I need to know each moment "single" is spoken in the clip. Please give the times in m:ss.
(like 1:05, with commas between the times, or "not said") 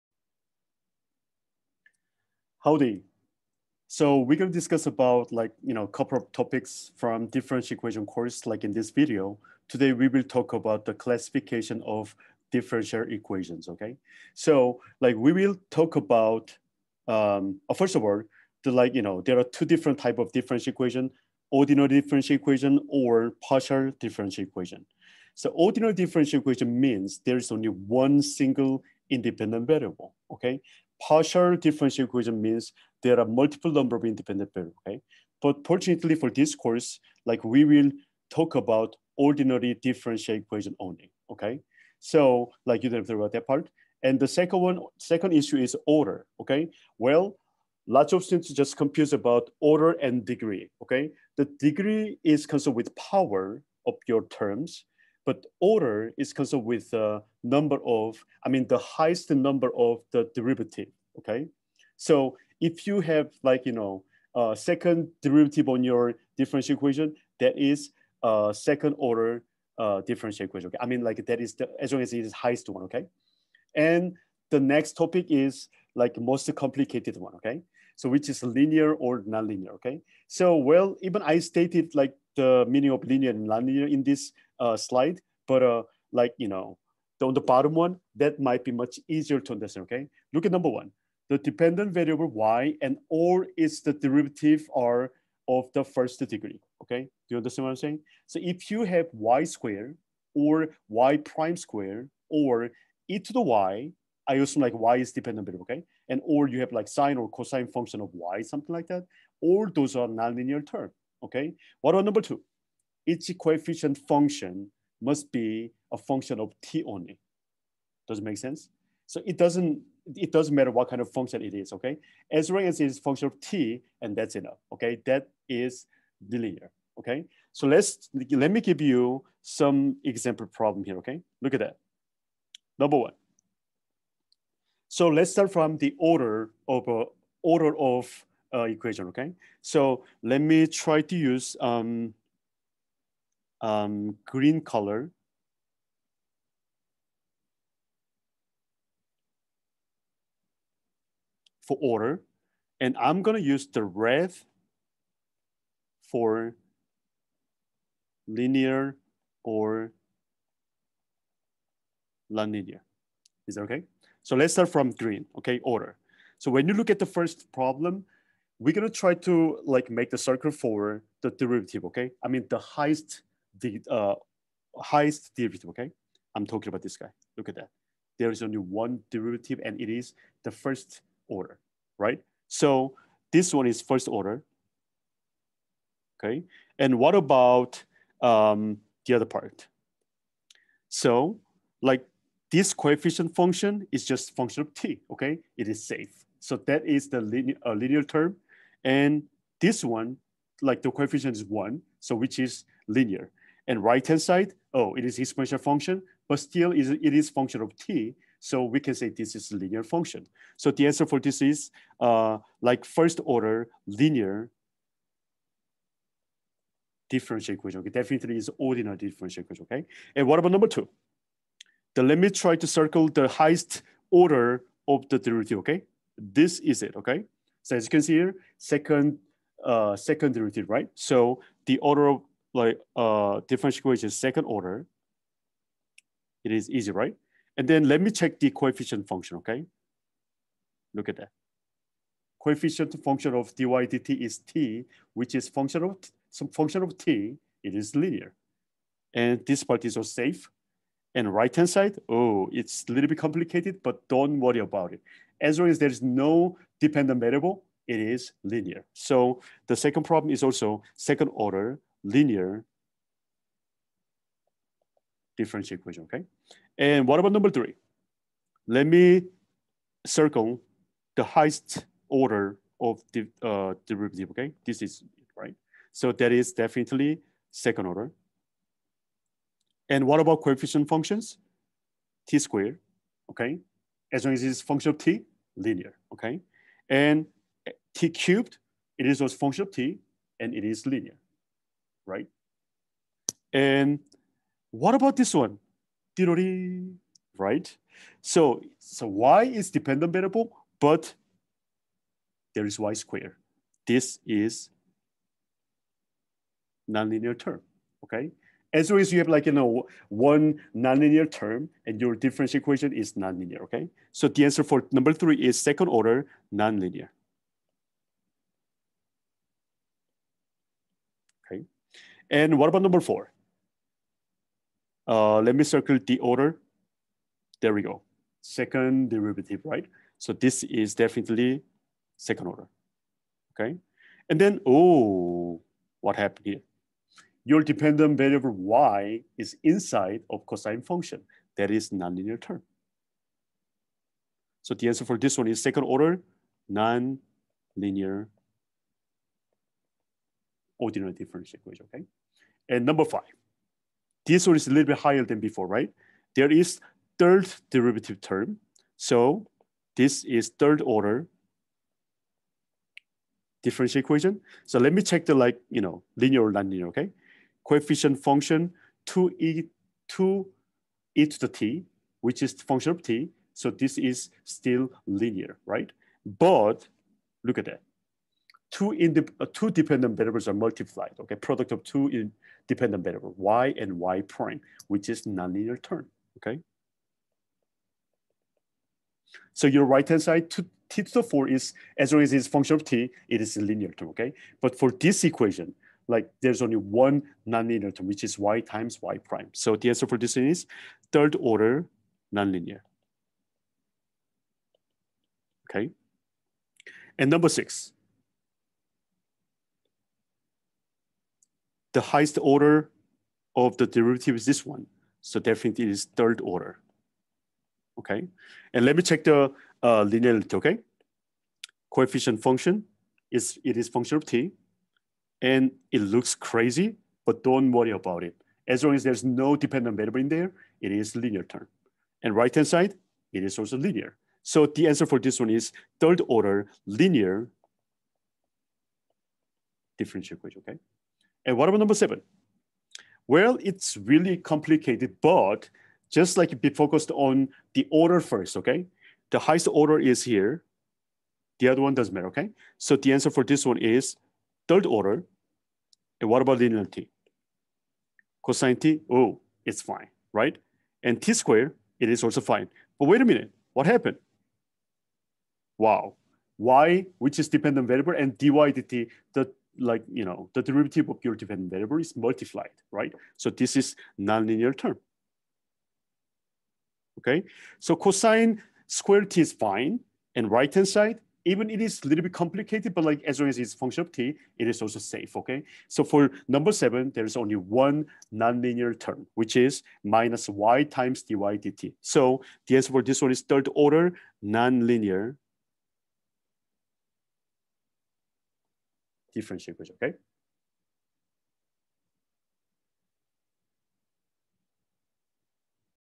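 0:28.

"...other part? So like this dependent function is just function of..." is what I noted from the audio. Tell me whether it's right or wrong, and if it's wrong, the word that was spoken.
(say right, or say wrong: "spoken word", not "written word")
wrong: "coefficient", not "dependent".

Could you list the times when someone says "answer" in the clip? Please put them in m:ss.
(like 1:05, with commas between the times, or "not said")
3:30, 5:14, 5:44, 6:39, 7:14, 7:33, 8:12.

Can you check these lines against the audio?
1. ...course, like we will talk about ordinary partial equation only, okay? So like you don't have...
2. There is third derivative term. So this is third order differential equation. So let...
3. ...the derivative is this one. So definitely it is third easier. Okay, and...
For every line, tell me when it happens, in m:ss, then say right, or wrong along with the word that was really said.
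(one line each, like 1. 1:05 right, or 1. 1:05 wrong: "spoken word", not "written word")
1. 0:36 wrong: "differential", not "partial"
2. 5:56 right
3. 6:53 wrong: "order", not "easier".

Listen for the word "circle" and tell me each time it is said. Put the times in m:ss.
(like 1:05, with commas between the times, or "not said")
2:50, 3:42, 4:30, 5:25.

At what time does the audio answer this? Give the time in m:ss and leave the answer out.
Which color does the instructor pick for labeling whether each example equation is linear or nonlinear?
2:33.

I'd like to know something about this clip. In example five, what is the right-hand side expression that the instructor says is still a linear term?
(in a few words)
2t^4.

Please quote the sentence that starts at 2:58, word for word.
There is only one derivative and it is the first order, right?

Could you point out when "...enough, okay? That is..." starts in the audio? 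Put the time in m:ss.
2:04.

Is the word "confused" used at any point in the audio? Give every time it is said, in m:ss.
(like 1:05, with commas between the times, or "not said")
0:48.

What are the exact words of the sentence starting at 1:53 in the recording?
each coefficient function must be a function of t only.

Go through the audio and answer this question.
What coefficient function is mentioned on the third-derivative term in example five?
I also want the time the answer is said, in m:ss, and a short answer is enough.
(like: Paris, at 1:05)
2e^t, at 6:10.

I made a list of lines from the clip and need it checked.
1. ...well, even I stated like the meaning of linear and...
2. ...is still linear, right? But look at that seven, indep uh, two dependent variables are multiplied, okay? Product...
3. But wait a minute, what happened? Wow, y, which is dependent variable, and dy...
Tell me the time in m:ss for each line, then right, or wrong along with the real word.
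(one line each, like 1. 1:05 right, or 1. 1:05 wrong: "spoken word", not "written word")
1. 1:20 right
2. 6:13 wrong: "two", not "seven"
3. 7:42 right.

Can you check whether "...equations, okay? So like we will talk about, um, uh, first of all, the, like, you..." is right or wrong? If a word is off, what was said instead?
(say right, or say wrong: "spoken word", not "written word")
right.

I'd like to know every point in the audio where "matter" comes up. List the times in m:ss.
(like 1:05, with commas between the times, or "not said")
2:00, 7:32.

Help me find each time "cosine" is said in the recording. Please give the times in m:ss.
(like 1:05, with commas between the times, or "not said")
1:47, 5:40, 7:38, 7:57.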